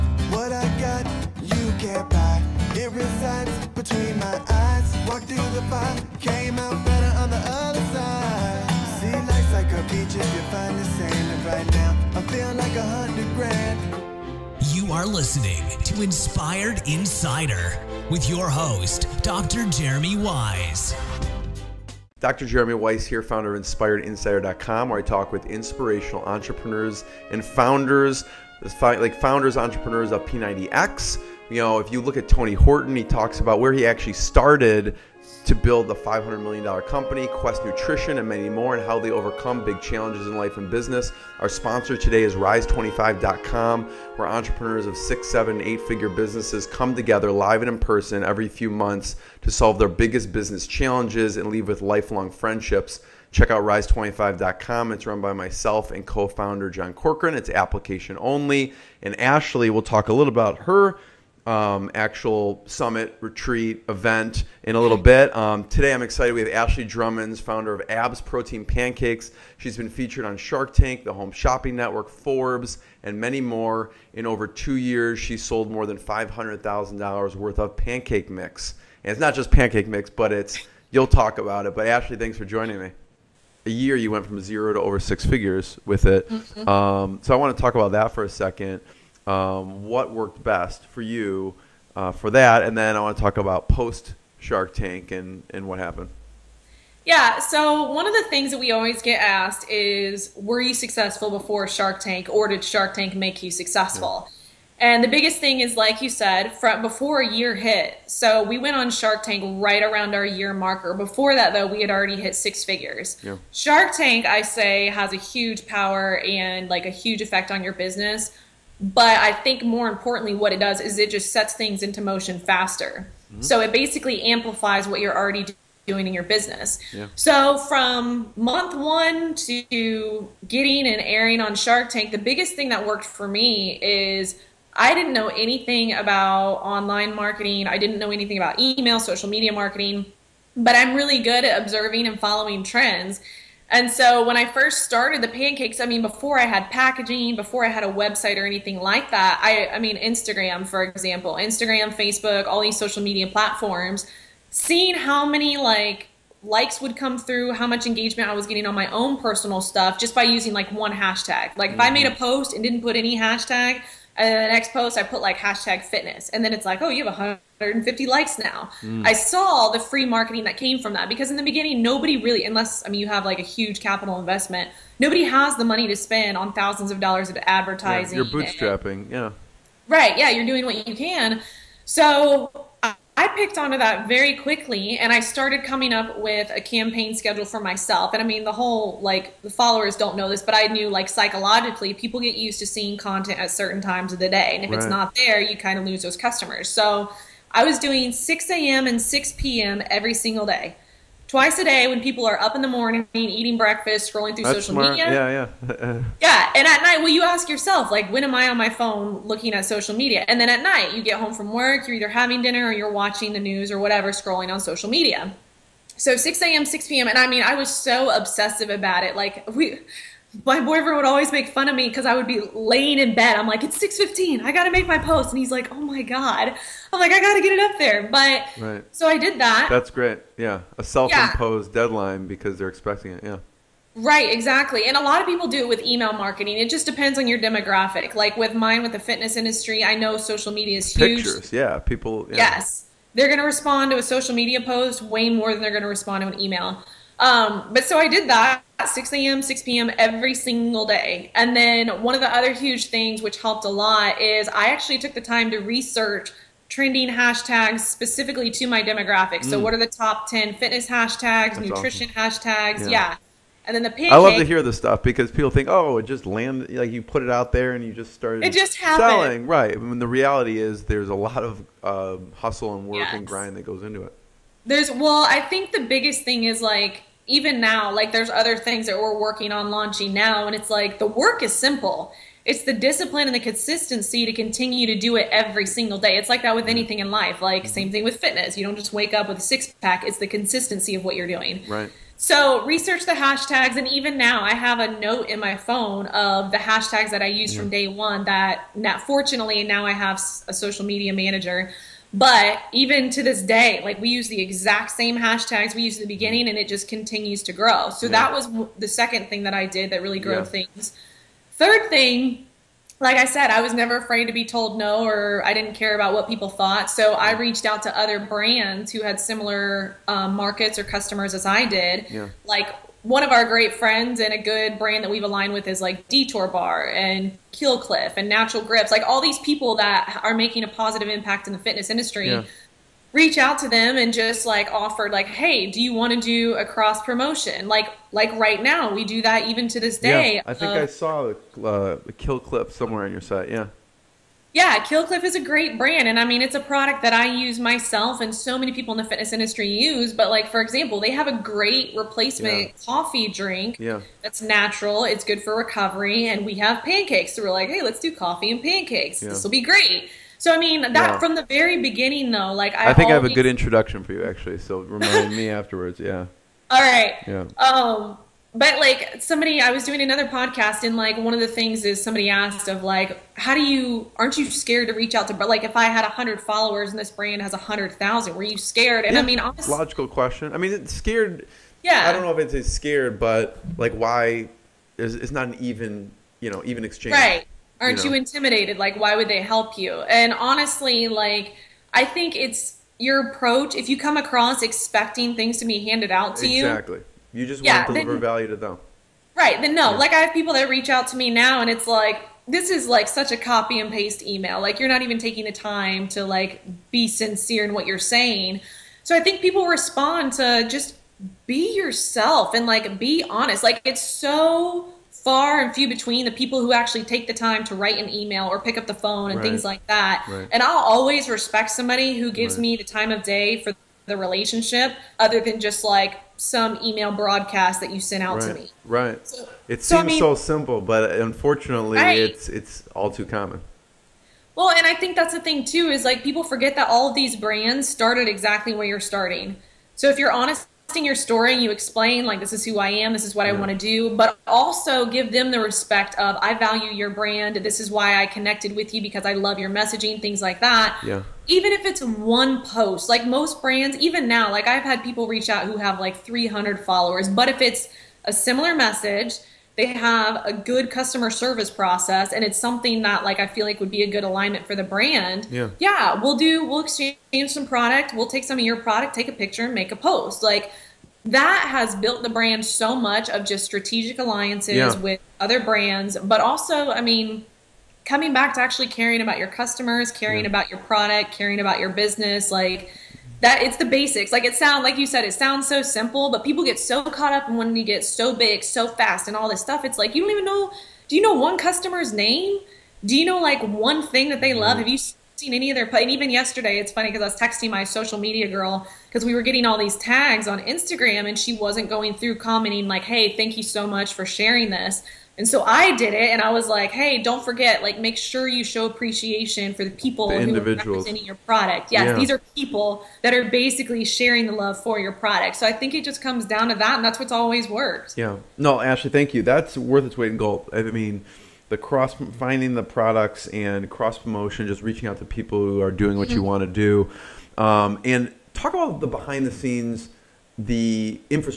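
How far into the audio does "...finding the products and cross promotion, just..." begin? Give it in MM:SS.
08:42.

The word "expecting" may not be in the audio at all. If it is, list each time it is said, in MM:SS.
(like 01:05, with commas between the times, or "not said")
03:52, 06:34.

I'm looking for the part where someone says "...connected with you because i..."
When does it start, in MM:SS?
07:28.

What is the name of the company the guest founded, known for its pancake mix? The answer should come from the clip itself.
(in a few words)
Abs Protein Pancakes.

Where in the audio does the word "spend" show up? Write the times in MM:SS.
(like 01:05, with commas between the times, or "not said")
02:55.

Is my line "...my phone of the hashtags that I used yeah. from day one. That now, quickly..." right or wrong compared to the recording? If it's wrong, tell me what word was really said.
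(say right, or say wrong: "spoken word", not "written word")
wrong: "fortunately", not "quickly".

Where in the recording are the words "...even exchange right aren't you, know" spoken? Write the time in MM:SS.
06:26.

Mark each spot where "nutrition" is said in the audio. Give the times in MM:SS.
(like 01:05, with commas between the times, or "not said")
00:37, 04:21.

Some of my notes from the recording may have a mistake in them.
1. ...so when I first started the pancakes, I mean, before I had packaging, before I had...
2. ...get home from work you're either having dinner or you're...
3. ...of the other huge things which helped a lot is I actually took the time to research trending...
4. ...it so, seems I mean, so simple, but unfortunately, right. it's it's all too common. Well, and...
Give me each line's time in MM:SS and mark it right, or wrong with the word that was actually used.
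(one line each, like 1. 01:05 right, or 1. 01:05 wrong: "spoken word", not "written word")
1. 02:23 right
2. 03:31 right
3. 04:12 right
4. 07:09 right.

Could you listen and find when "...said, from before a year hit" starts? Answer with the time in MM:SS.
01:46.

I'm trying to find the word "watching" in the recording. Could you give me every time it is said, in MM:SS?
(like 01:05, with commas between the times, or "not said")
03:32.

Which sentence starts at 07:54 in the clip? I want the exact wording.
with other brands, but also, I mean, coming back to actually caring about your customers, caring yeah.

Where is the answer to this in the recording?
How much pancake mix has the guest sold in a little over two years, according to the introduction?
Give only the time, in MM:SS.
01:15.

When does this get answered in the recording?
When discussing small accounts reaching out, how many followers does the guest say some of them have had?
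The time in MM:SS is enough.
07:36.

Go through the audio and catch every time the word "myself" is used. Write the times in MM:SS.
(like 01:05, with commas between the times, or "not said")
00:55, 03:07, 05:47.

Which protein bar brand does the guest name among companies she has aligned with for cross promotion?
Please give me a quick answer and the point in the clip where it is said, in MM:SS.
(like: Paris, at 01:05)
Detour Bar, at 05:26.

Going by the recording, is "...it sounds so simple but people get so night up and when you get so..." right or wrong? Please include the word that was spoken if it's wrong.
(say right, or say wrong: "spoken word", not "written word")
wrong: "caught", not "night".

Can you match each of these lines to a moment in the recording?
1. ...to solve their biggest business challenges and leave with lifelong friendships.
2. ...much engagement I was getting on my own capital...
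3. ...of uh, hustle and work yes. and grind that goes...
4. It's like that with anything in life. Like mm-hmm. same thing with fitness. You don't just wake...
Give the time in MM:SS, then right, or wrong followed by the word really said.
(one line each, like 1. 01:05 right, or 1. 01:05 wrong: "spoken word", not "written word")
1. 00:49 right
2. 02:37 wrong: "personal", not "capital"
3. 04:31 right
4. 04:46 right.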